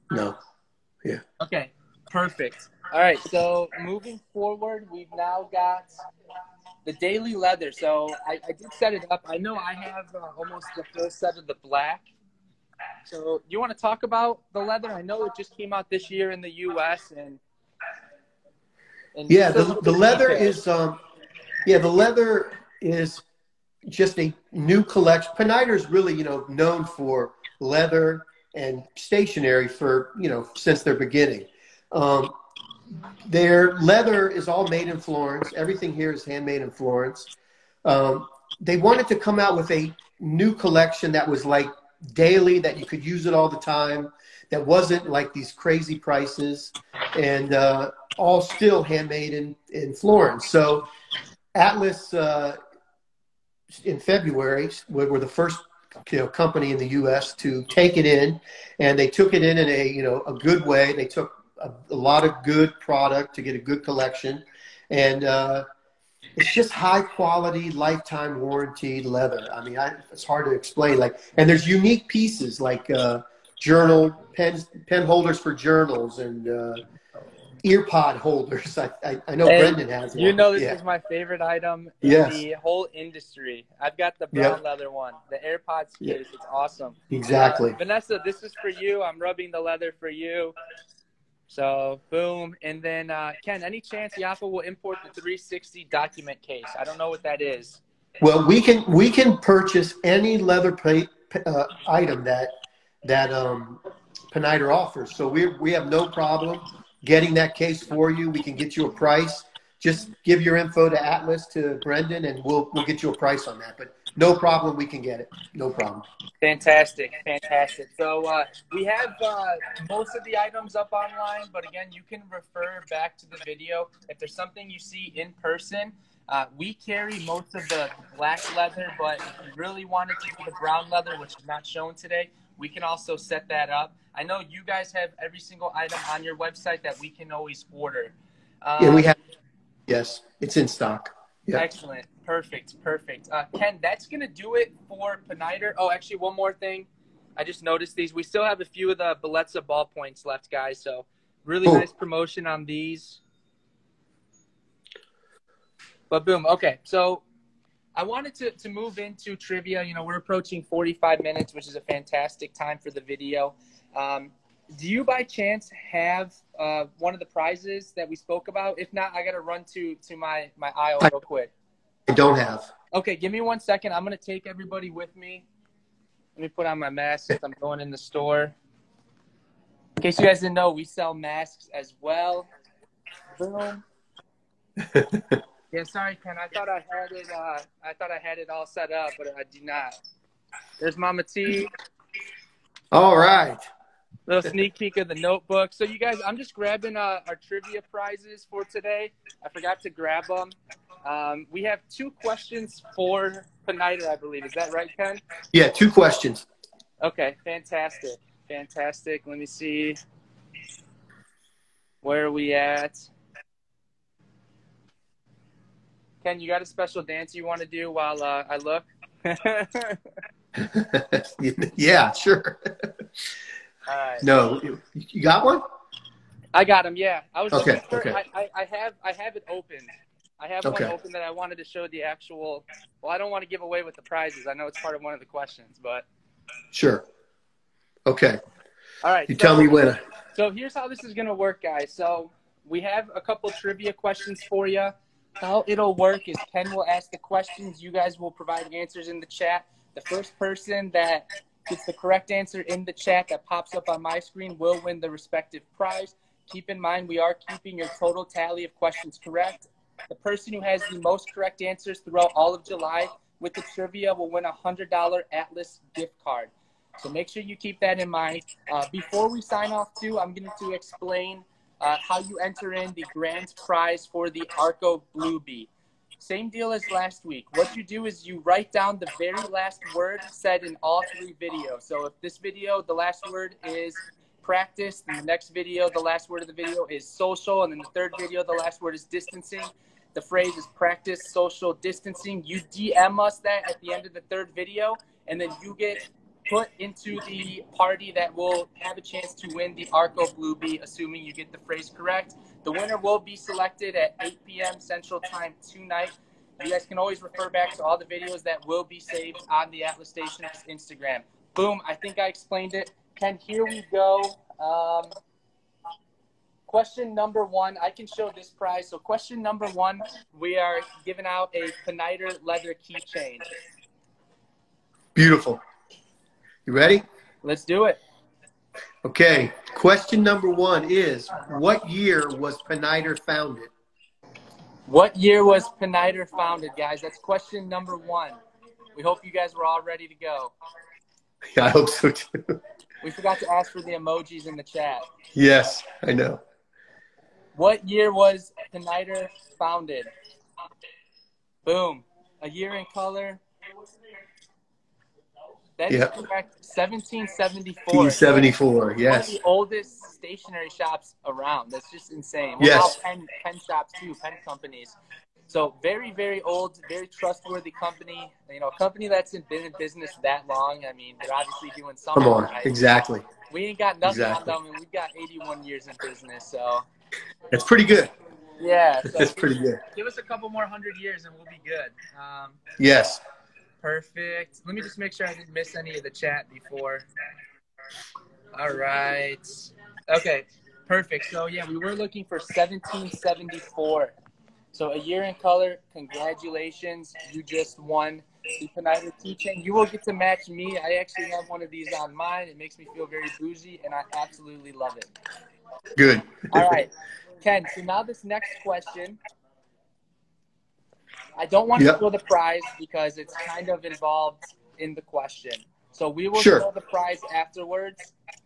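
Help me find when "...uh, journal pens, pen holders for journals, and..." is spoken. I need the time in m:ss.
1:12.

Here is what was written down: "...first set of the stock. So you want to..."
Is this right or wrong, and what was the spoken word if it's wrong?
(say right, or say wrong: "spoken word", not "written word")
wrong: "black", not "stock".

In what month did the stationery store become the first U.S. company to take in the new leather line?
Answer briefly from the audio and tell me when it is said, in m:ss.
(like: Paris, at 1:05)
February, at 0:53.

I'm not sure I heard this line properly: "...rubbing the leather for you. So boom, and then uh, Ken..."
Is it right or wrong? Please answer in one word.
right.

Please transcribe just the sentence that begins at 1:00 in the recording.
They took a, a lot of good product to get a good collection, and uh, it's just high quality, lifetime warranty leather.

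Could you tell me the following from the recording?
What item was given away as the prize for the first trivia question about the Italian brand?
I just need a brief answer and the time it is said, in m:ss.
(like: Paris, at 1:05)
leather keychain, at 5:22.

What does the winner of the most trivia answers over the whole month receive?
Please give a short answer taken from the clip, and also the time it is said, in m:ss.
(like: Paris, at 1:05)
$100 Atlas gift card, at 4:24.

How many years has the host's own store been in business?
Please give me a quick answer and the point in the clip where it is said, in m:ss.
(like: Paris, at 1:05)
81, at 6:15.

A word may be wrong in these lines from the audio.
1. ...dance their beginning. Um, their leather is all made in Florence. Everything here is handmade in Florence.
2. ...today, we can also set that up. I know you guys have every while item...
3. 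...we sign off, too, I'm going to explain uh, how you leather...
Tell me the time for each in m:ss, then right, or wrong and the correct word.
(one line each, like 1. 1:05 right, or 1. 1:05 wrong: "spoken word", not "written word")
1. 0:30 wrong: "since", not "dance"
2. 2:11 wrong: "single", not "while"
3. 4:29 wrong: "enter", not "leather".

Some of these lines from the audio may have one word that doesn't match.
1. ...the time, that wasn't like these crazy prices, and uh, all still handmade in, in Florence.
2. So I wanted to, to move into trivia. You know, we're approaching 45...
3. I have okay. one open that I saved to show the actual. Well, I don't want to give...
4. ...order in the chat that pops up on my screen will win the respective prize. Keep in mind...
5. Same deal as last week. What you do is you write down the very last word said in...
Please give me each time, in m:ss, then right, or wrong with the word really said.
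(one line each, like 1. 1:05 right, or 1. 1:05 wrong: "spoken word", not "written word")
1. 0:43 right
2. 2:36 right
3. 3:50 wrong: "wanted", not "saved"
4. 4:12 wrong: "answer", not "order"
5. 4:36 right.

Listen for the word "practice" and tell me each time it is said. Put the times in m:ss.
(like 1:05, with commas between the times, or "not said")
4:44, 4:50.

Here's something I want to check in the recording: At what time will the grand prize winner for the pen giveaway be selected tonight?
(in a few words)
8 p.m. Central Time.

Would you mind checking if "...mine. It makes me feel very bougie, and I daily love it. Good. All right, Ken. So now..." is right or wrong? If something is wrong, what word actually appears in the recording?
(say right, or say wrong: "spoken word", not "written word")
wrong: "absolutely", not "daily".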